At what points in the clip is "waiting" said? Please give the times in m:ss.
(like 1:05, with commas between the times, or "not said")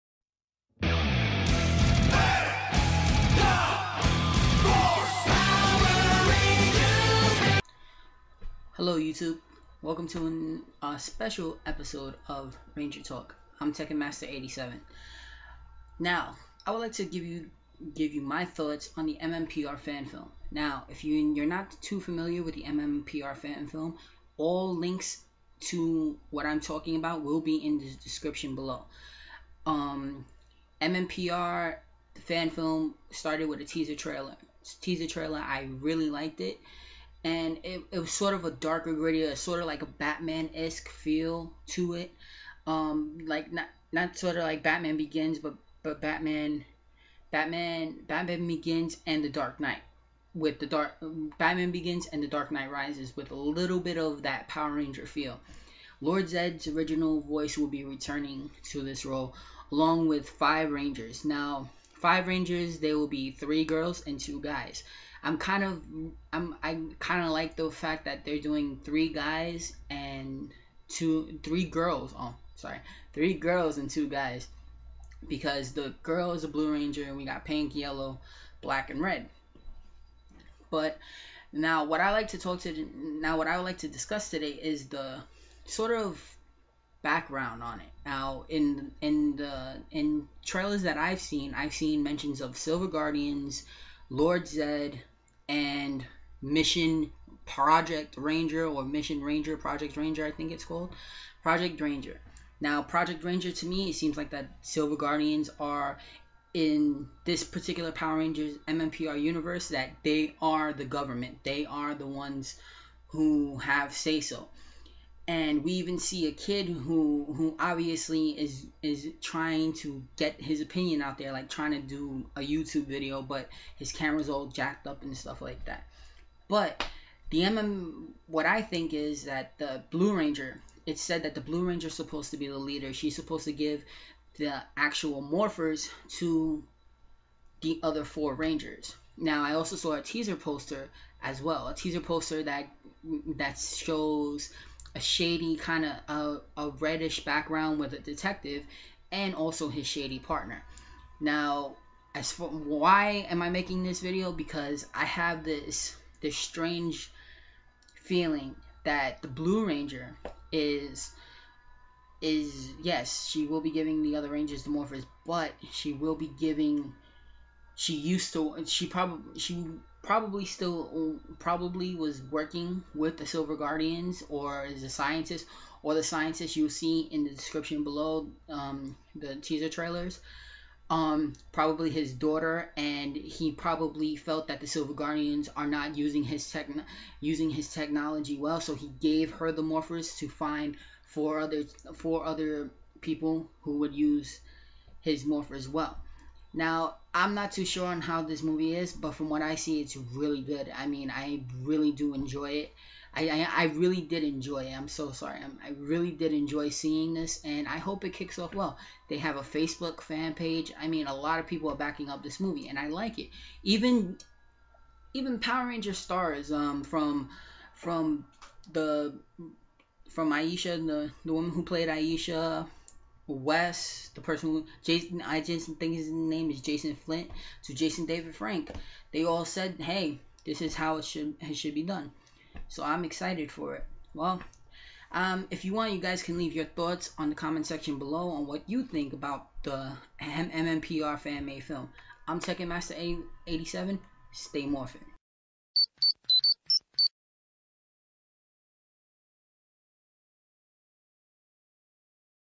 not said.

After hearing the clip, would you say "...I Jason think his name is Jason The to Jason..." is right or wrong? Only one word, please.
wrong.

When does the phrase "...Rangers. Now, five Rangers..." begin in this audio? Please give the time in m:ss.
1:00.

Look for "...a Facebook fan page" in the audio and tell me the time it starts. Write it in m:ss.
3:29.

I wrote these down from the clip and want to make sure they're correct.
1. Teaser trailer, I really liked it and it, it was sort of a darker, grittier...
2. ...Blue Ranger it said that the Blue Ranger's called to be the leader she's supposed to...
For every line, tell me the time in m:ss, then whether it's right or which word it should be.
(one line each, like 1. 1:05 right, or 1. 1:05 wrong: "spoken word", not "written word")
1. 0:34 right
2. 2:09 wrong: "supposed", not "called".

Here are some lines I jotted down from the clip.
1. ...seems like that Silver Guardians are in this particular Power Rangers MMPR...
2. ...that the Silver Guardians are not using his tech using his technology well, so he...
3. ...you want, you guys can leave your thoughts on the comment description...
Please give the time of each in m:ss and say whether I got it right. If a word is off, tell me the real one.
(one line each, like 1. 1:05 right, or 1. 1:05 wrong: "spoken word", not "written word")
1. 1:43 right
2. 3:04 right
3. 3:55 wrong: "section", not "description".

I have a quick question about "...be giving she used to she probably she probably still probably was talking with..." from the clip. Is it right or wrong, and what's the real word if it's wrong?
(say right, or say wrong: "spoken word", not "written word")
wrong: "working", not "talking".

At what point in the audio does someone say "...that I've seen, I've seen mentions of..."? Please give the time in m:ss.
1:30.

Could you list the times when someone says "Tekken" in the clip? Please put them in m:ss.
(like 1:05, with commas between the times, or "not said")
0:13, 4:02.